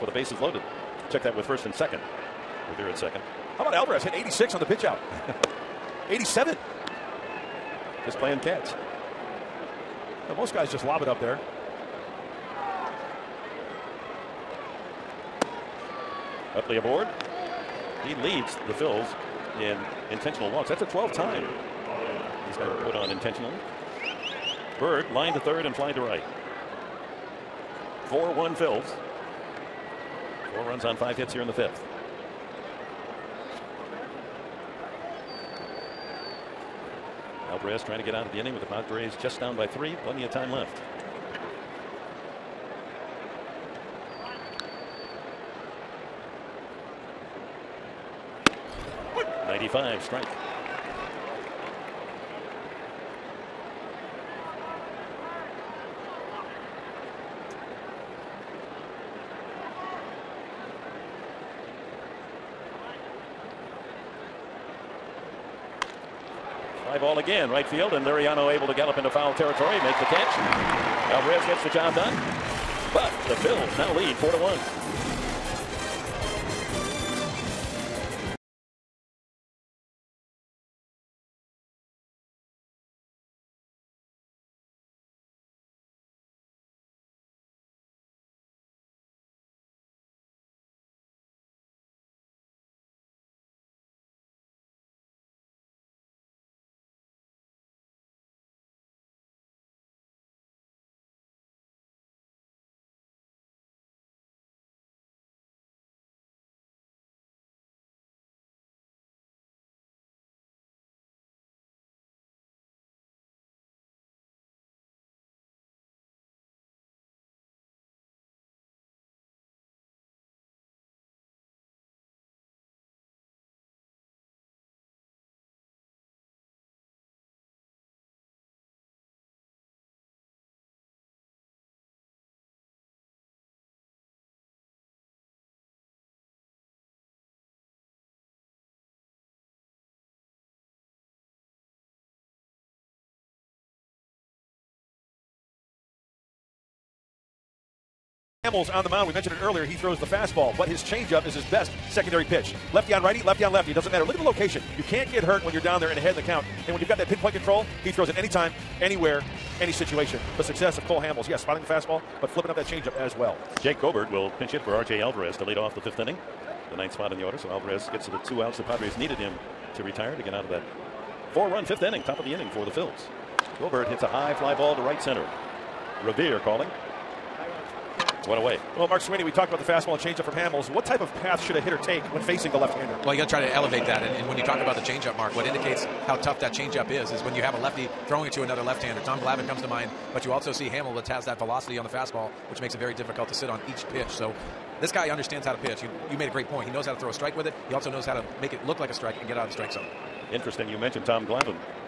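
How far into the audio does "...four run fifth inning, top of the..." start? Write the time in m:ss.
2:51.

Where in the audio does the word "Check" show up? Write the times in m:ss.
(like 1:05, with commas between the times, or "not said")
0:01.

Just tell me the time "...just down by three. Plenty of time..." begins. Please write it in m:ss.
0:39.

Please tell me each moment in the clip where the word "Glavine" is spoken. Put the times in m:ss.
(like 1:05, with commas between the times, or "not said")
3:09, 3:21.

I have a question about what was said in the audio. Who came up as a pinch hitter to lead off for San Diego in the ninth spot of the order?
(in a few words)
Jake Goebbert.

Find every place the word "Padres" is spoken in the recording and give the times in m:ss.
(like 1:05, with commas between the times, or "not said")
0:38, 2:48.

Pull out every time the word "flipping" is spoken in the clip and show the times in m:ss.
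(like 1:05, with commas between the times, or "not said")
2:42.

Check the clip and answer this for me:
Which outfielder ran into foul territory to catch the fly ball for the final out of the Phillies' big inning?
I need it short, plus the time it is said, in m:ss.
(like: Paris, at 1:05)
Liriano, at 1:08.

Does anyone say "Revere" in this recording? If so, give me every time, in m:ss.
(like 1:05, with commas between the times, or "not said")
0:02, 2:56.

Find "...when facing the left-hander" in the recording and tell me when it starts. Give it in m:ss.
3:02.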